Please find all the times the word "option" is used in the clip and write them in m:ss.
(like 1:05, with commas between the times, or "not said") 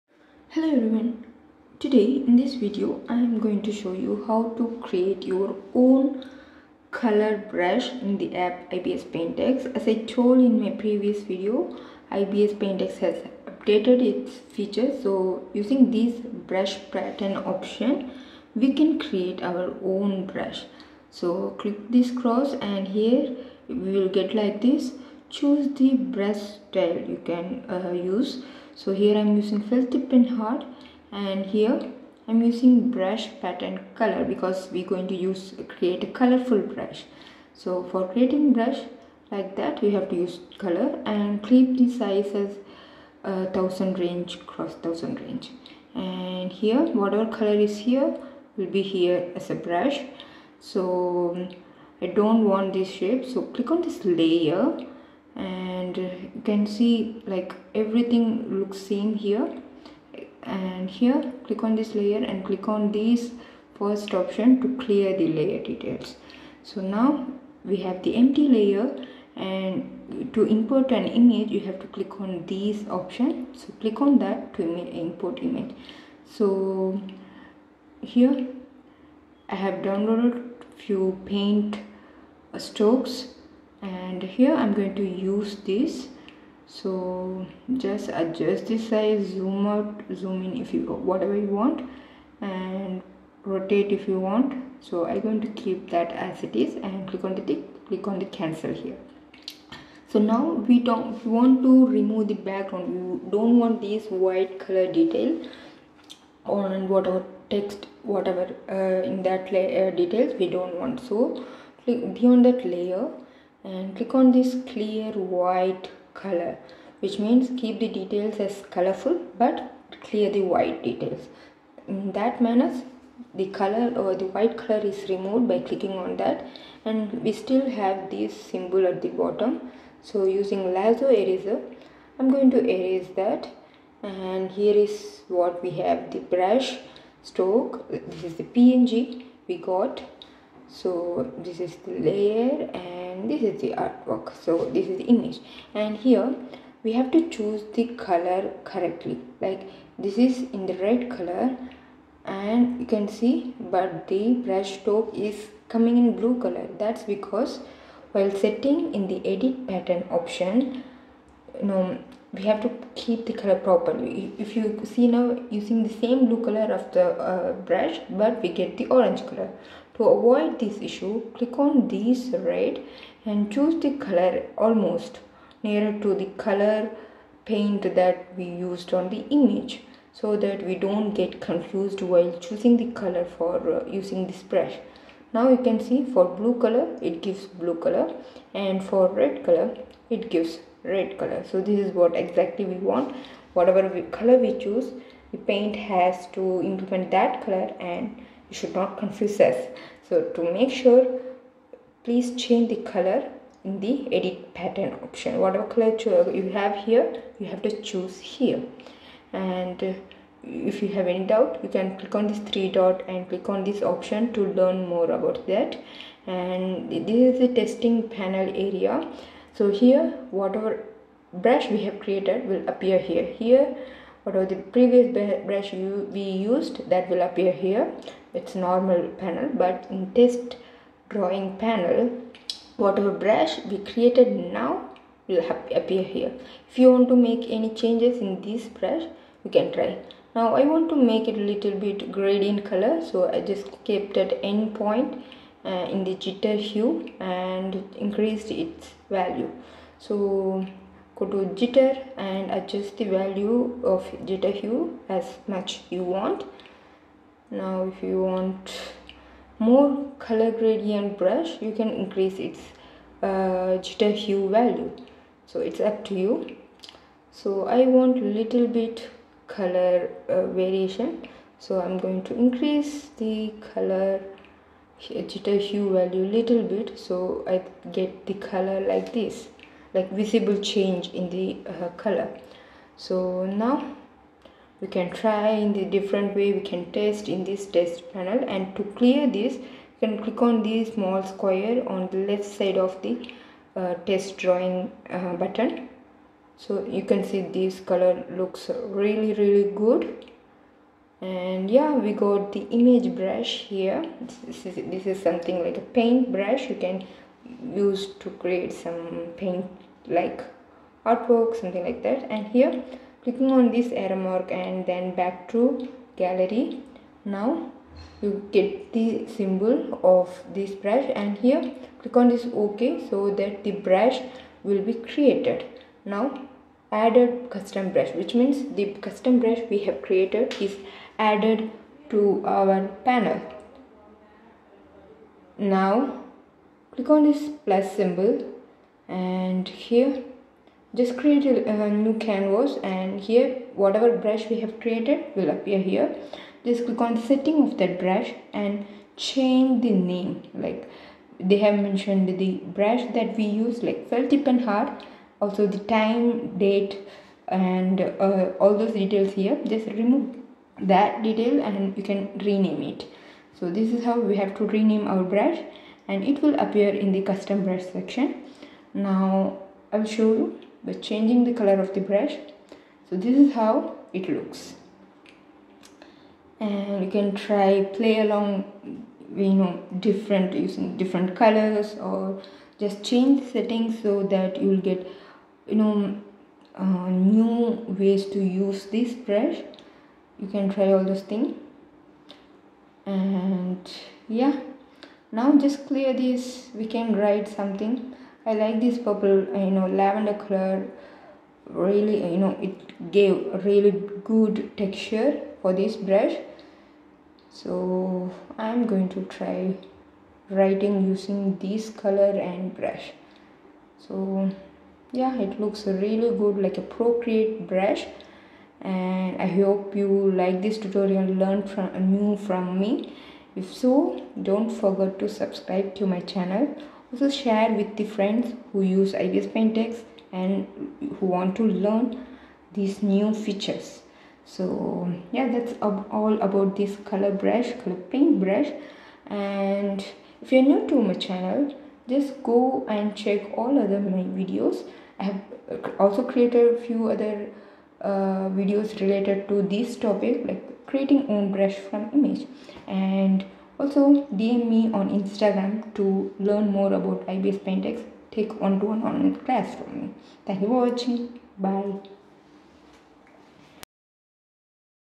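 0:17, 1:04, 1:12, 2:40, 3:25, 3:33.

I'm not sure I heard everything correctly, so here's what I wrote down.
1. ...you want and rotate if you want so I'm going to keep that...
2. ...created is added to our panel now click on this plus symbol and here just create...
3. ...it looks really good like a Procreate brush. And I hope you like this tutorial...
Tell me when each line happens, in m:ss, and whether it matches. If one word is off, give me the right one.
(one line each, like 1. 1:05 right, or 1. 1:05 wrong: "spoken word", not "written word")
1. 1:31 right
2. 5:30 right
3. 6:55 right.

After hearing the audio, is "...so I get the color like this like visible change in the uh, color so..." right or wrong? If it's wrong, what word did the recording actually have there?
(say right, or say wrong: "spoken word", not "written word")
right.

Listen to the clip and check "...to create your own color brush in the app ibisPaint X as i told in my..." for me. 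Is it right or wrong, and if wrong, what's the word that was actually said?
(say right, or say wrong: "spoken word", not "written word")
right.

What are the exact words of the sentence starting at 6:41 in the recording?
Really, you know, it gave really good texture for this brush.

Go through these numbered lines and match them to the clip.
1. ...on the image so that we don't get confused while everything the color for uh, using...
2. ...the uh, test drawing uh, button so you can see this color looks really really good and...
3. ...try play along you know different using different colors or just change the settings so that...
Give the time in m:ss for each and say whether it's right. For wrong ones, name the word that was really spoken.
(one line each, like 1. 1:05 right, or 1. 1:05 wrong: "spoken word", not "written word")
1. 2:58 wrong: "choosing", not "everything"
2. 4:53 right
3. 6:17 right.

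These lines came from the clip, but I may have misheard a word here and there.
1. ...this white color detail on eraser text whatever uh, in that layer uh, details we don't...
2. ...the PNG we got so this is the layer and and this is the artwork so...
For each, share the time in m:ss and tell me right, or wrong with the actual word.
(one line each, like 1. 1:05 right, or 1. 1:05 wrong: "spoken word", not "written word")
1. 1:43 wrong: "whatever", not "eraser"
2. 2:18 right.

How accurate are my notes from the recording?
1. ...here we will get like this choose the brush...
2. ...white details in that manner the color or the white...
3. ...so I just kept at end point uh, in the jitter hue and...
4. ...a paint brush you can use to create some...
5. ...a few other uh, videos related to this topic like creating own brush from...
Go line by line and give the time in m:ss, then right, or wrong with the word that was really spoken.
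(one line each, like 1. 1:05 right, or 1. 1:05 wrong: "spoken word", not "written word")
1. 0:22 right
2. 2:00 right
3. 4:03 right
4. 5:05 right
5. 7:26 right.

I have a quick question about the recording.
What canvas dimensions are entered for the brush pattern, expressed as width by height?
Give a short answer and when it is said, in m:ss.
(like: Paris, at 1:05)
1000 x 1000, at 0:43.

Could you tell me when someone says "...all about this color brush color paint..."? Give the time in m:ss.
7:15.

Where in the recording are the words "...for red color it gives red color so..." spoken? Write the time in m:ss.
3:08.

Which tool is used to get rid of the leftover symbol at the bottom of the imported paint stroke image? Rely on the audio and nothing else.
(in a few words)
lasso eraser.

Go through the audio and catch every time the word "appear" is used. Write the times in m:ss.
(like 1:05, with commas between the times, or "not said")
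3:42, 3:47, 3:55, 5:45, 6:06.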